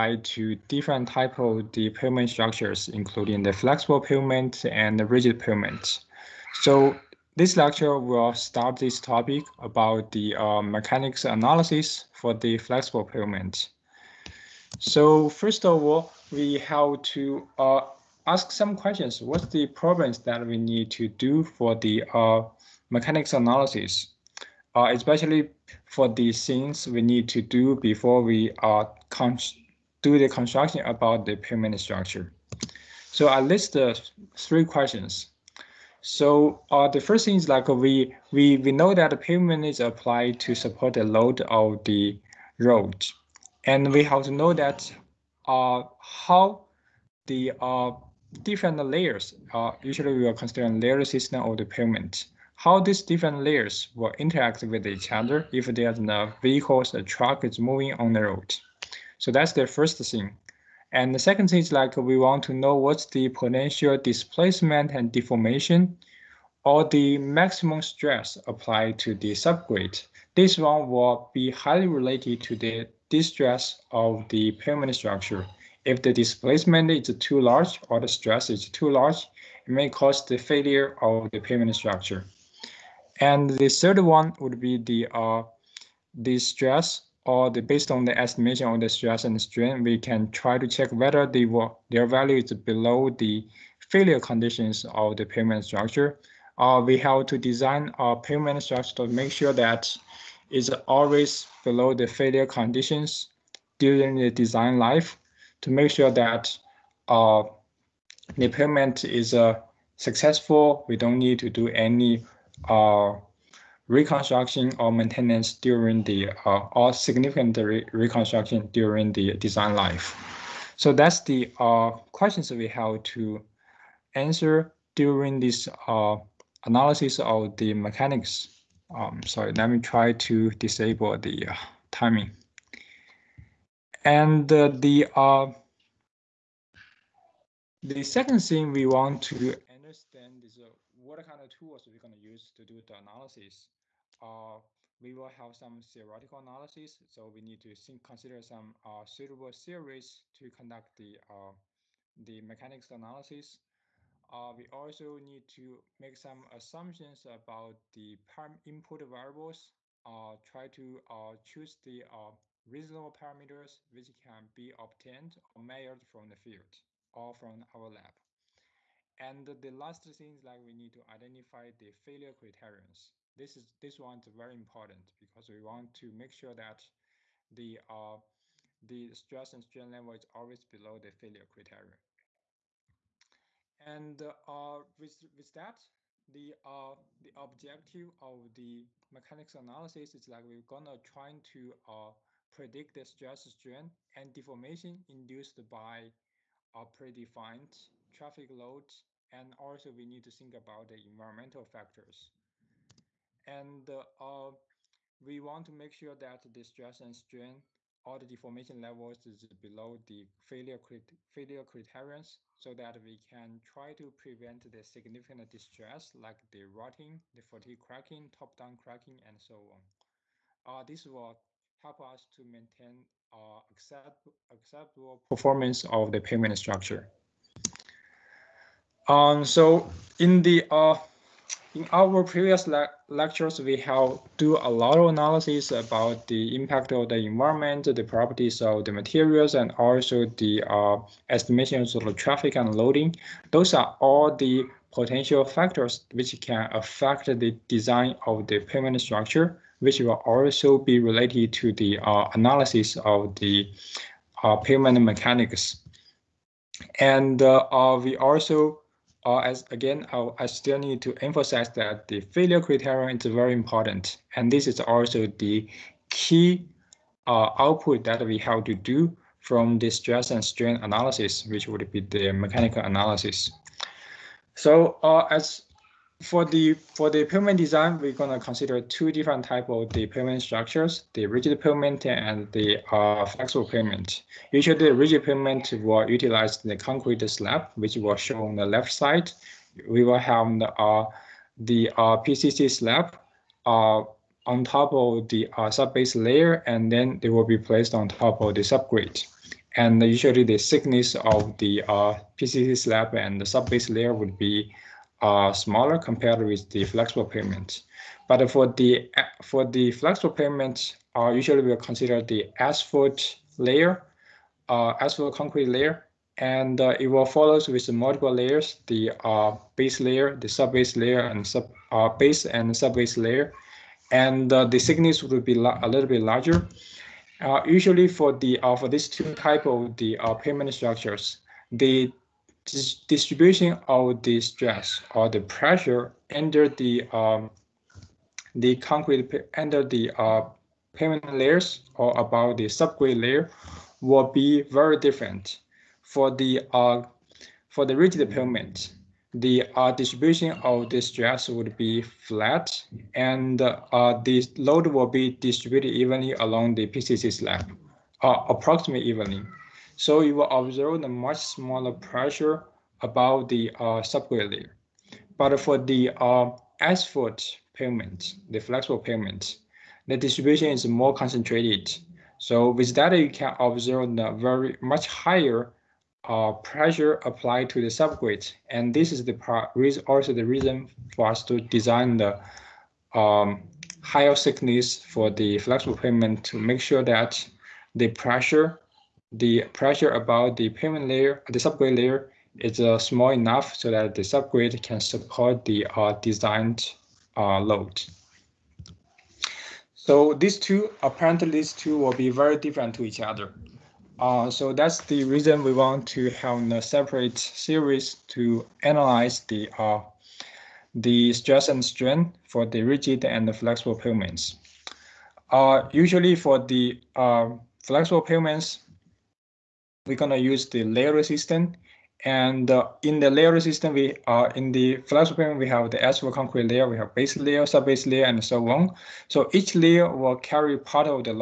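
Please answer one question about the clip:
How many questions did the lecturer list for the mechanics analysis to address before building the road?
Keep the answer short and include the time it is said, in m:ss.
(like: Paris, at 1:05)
3, at 0:34.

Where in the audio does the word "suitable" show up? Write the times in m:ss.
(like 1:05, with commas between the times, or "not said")
2:29.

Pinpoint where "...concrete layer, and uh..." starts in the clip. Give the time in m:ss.
5:15.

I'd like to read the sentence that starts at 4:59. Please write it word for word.
And usually, the thickness of the uh, PCC slab and the subbase layer would be are smaller compared with the flexible pavement.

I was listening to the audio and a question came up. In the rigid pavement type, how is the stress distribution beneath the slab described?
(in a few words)
Flat.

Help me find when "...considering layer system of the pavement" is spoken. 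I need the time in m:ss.
0:50.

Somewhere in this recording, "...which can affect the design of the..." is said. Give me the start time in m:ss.
4:06.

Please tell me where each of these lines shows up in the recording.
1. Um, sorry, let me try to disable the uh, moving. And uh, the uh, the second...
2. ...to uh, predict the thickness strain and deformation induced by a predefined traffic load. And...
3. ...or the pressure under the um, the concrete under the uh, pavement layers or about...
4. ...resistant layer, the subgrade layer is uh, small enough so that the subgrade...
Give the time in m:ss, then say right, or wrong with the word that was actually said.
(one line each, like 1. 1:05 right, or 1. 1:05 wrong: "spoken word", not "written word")
1. 2:08 wrong: "timing", not "moving"
2. 3:11 wrong: "stress", not "thickness"
3. 5:35 right
4. 6:30 wrong: "pavement", not "resistant".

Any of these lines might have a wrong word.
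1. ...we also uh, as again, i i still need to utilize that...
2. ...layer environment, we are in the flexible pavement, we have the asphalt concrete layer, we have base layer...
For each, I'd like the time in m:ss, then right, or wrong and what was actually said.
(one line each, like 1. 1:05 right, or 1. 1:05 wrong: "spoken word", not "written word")
1. 4:18 wrong: "emphasize", not "utilize"
2. 7:03 wrong: "resistant", not "environment".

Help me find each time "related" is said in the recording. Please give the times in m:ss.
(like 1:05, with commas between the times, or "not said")
1:11, 4:10.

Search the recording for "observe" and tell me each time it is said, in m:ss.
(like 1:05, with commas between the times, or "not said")
6:00, 6:13.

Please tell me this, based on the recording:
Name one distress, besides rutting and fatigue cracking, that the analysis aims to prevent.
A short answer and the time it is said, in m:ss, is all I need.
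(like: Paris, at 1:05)
Top-down cracking, at 3:38.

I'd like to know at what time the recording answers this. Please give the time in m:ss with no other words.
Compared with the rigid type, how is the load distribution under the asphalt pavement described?
6:10.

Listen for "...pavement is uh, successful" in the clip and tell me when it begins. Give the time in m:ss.
1:48.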